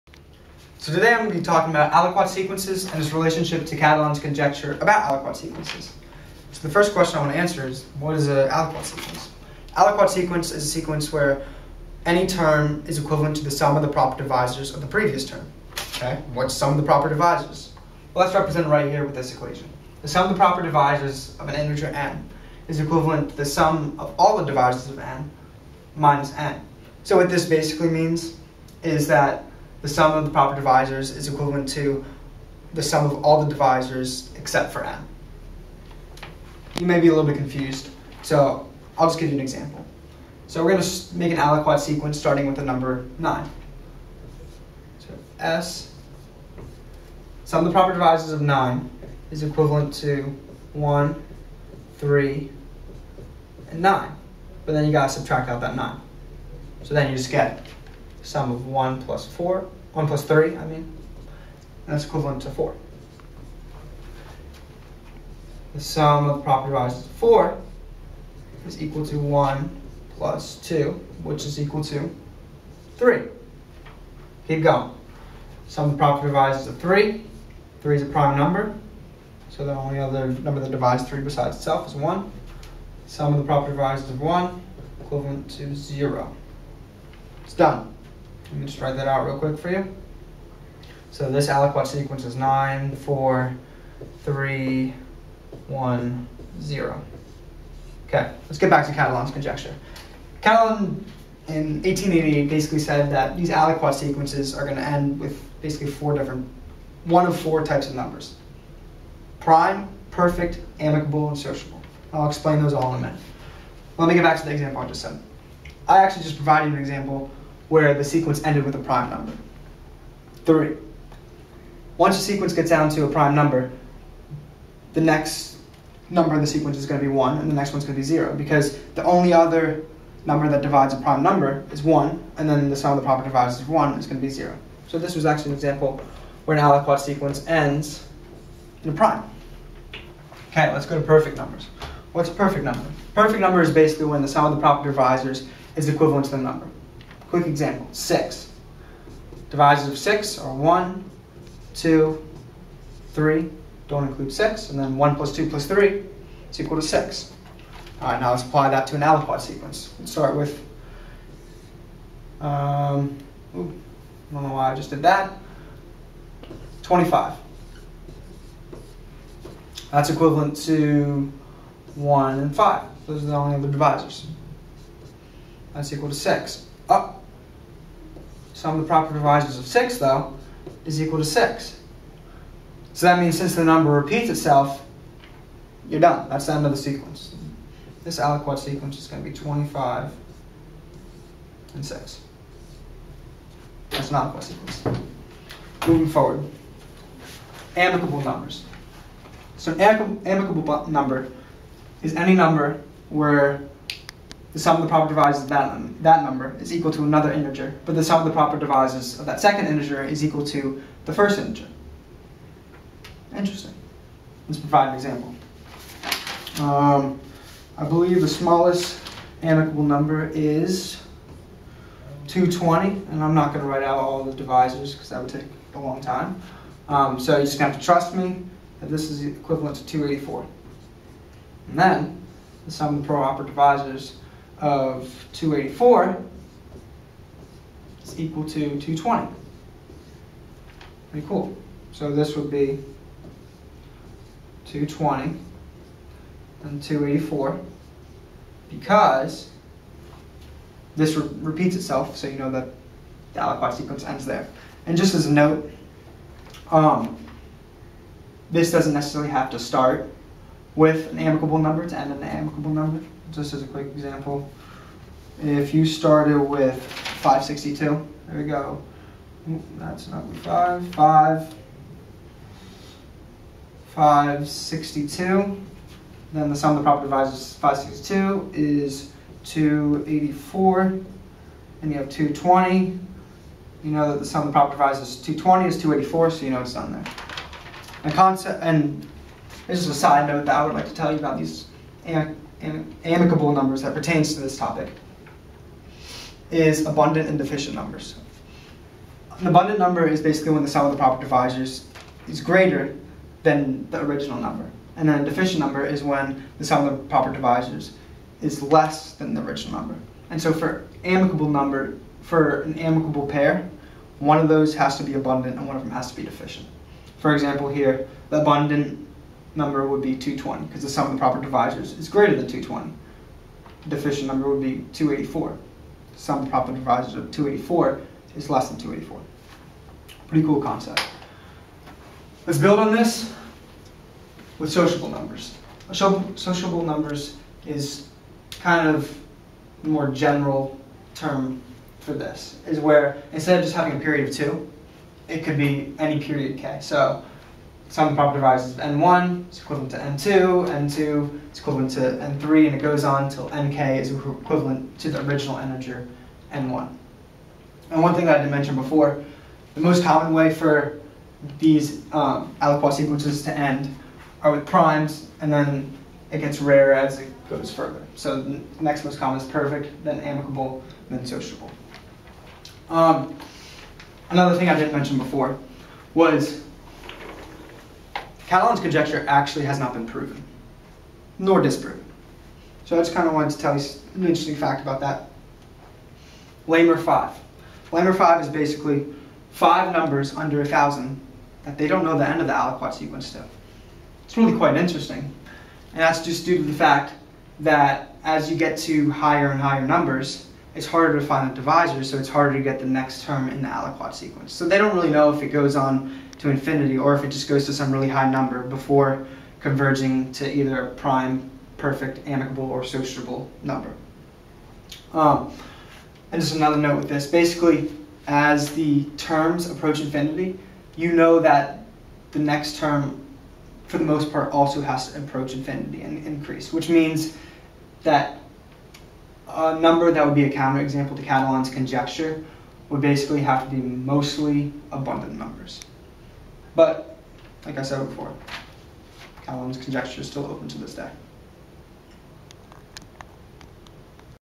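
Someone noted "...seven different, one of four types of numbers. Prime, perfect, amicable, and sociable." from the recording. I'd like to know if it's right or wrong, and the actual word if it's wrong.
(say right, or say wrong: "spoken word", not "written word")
wrong: "four", not "seven".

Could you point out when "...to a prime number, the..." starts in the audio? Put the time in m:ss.
2:02.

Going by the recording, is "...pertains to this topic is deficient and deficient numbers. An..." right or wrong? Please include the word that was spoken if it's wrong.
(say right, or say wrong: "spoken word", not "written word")
wrong: "abundant", not "deficient".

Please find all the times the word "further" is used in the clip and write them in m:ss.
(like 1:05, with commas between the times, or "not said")
6:07.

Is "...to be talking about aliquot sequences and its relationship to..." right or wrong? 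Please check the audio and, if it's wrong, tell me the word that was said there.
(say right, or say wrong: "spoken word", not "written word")
right.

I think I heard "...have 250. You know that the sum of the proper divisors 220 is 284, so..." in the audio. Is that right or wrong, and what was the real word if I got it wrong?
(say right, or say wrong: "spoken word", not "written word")
wrong: "220", not "250".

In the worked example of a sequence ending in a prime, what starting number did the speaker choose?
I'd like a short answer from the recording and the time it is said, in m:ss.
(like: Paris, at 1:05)
9, at 0:42.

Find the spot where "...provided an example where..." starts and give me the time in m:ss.
1:56.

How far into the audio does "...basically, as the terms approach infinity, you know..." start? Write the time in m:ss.
6:57.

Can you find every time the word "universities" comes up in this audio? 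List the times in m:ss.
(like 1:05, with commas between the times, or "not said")
not said.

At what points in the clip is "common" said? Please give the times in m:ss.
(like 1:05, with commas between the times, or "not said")
6:00, 6:09.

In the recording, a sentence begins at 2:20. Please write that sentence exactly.
Okay, let's go to perfect numbers.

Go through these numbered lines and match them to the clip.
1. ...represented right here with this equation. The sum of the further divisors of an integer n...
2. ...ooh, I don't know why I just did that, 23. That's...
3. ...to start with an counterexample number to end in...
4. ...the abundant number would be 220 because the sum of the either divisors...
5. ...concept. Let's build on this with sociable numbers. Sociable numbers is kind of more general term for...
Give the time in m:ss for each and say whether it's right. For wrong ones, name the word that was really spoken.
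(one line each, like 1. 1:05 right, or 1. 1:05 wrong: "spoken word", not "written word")
1. 0:18 wrong: "proper", not "further"
2. 2:43 wrong: "25", not "23"
3. 4:19 wrong: "amicable", not "counterexample"
4. 5:18 wrong: "proper", not "either"
5. 5:30 right.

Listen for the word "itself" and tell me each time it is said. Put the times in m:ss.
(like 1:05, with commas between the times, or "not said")
1:21, 3:04, 4:11.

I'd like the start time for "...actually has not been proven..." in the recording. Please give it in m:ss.
6:19.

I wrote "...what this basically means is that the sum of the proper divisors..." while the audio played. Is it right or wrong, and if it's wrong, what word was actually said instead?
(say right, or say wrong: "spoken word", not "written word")
right.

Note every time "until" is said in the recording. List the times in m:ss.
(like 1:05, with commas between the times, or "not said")
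5:53.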